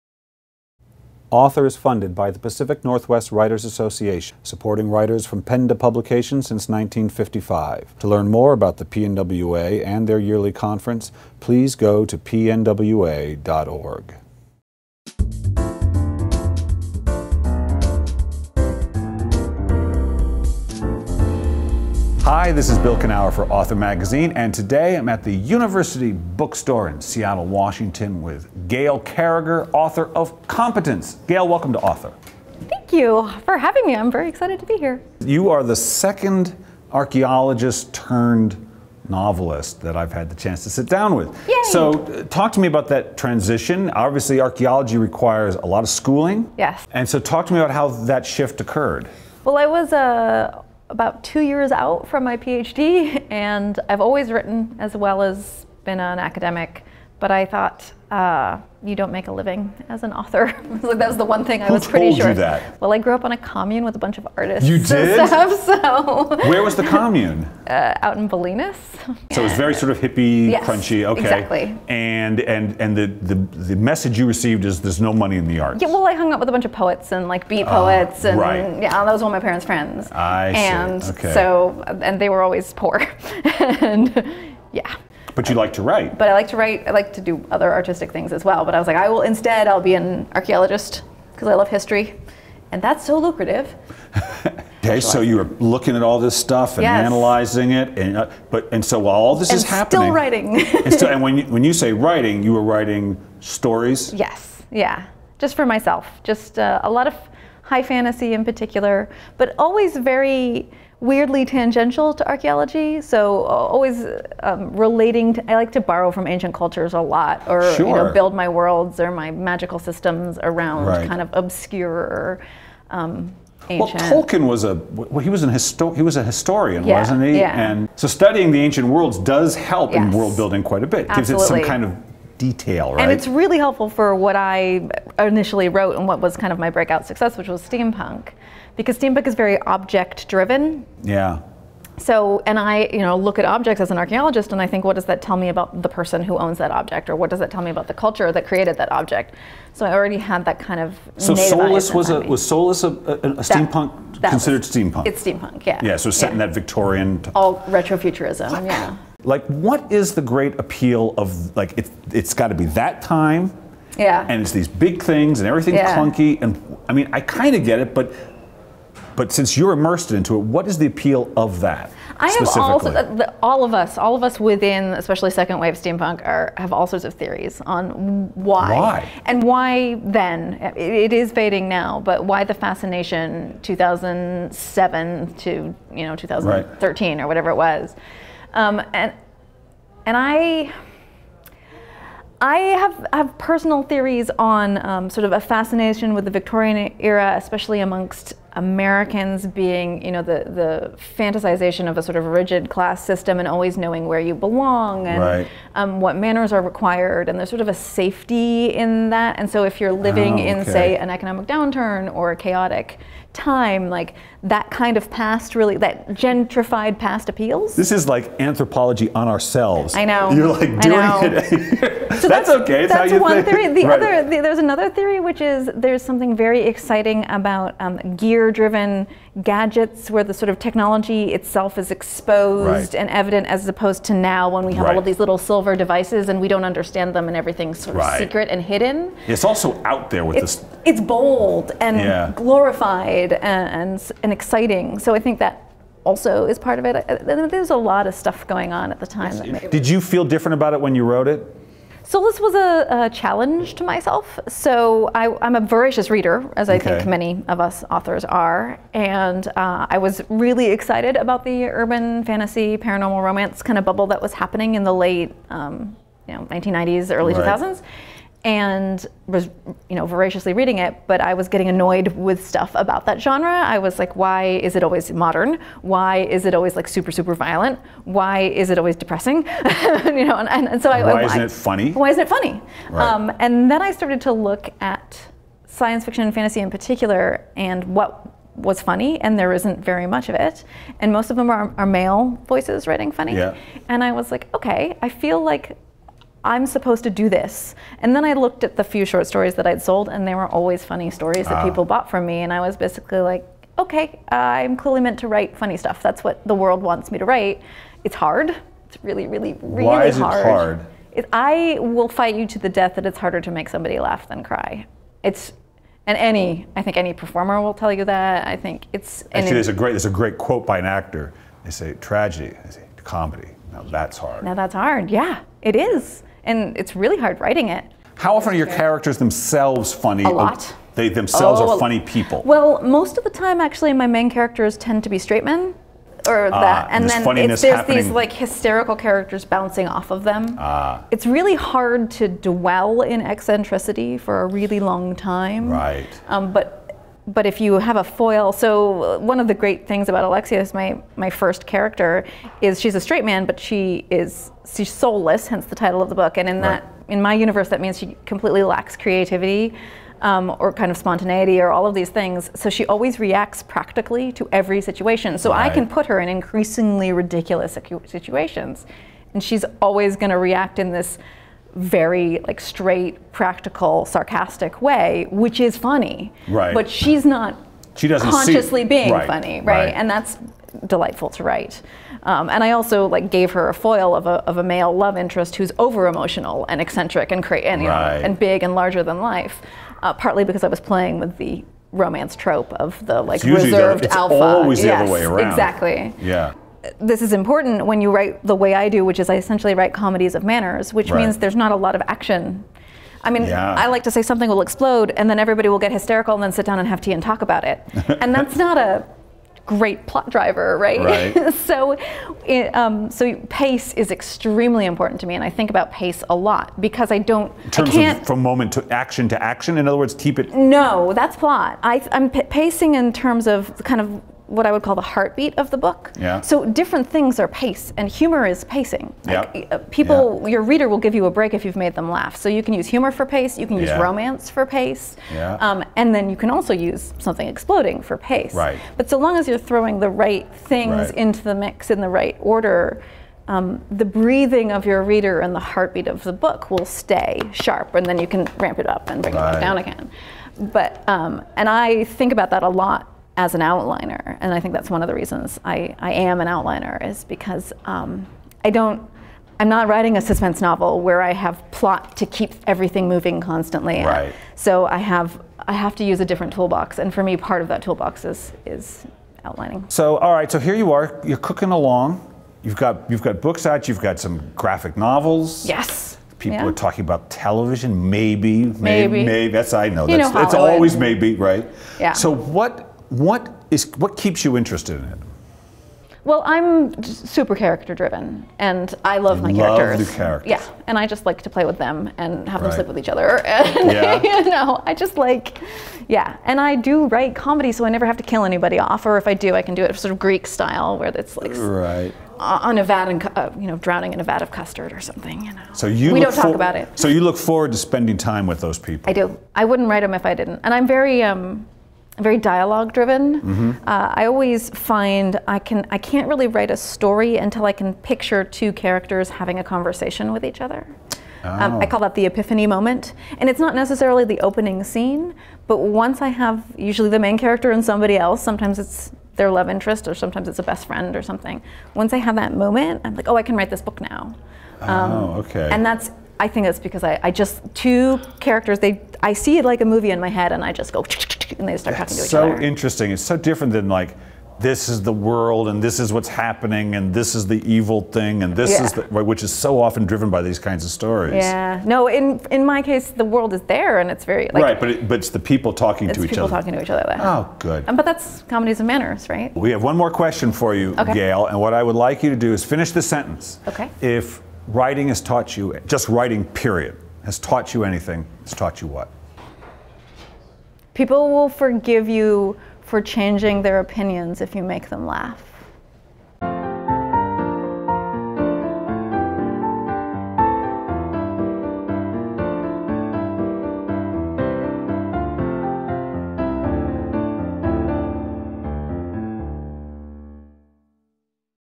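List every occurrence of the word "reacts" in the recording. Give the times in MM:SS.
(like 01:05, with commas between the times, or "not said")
06:03, 06:10.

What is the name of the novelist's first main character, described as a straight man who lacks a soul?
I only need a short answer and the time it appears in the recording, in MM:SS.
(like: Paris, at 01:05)
Alexia, at 05:50.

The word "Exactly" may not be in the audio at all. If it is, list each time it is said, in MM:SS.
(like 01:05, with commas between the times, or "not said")
01:11, 06:35.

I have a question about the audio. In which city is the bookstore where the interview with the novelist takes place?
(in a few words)
Seattle.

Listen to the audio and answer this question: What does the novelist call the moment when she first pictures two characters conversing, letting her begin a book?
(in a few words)
The epiphany moment.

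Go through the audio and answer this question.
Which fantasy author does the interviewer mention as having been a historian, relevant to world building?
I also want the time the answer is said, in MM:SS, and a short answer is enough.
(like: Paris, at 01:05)
Tolkien, at 02:04.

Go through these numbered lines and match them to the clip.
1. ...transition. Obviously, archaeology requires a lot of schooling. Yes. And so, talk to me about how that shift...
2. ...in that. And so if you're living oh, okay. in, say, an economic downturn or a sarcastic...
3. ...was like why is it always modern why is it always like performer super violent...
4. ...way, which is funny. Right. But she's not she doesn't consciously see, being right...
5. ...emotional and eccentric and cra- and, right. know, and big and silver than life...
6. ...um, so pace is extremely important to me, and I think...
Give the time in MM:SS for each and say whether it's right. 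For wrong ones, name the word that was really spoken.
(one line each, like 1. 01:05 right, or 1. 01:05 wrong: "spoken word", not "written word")
1. 00:43 right
2. 03:28 wrong: "chaotic", not "sarcastic"
3. 04:33 wrong: "super", not "performer"
4. 06:14 right
5. 06:26 wrong: "larger", not "silver"
6. 06:52 right.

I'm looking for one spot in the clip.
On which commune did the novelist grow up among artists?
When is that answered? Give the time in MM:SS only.
01:08.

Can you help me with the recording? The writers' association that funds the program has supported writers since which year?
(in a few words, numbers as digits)
1955.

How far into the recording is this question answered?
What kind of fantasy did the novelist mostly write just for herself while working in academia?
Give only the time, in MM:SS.
01:47.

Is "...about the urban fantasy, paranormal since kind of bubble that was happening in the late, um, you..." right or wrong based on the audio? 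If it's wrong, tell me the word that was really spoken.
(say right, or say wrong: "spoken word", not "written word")
wrong: "romance", not "since".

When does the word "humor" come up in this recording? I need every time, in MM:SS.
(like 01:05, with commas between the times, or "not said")
07:08, 07:12.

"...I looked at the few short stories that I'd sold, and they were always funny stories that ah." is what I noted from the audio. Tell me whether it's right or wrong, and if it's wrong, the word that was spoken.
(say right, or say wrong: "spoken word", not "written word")
right.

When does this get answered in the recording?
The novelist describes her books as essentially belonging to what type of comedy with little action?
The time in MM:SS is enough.
06:39.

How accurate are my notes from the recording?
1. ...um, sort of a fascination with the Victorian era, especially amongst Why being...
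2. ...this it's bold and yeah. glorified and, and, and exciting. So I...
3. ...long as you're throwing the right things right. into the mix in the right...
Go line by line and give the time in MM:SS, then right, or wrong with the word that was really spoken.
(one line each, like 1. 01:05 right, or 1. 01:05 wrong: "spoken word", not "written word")
1. 03:14 wrong: "Americans", not "Why"
2. 04:00 right
3. 07:19 right.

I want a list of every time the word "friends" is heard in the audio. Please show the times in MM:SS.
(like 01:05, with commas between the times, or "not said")
01:19, 08:50.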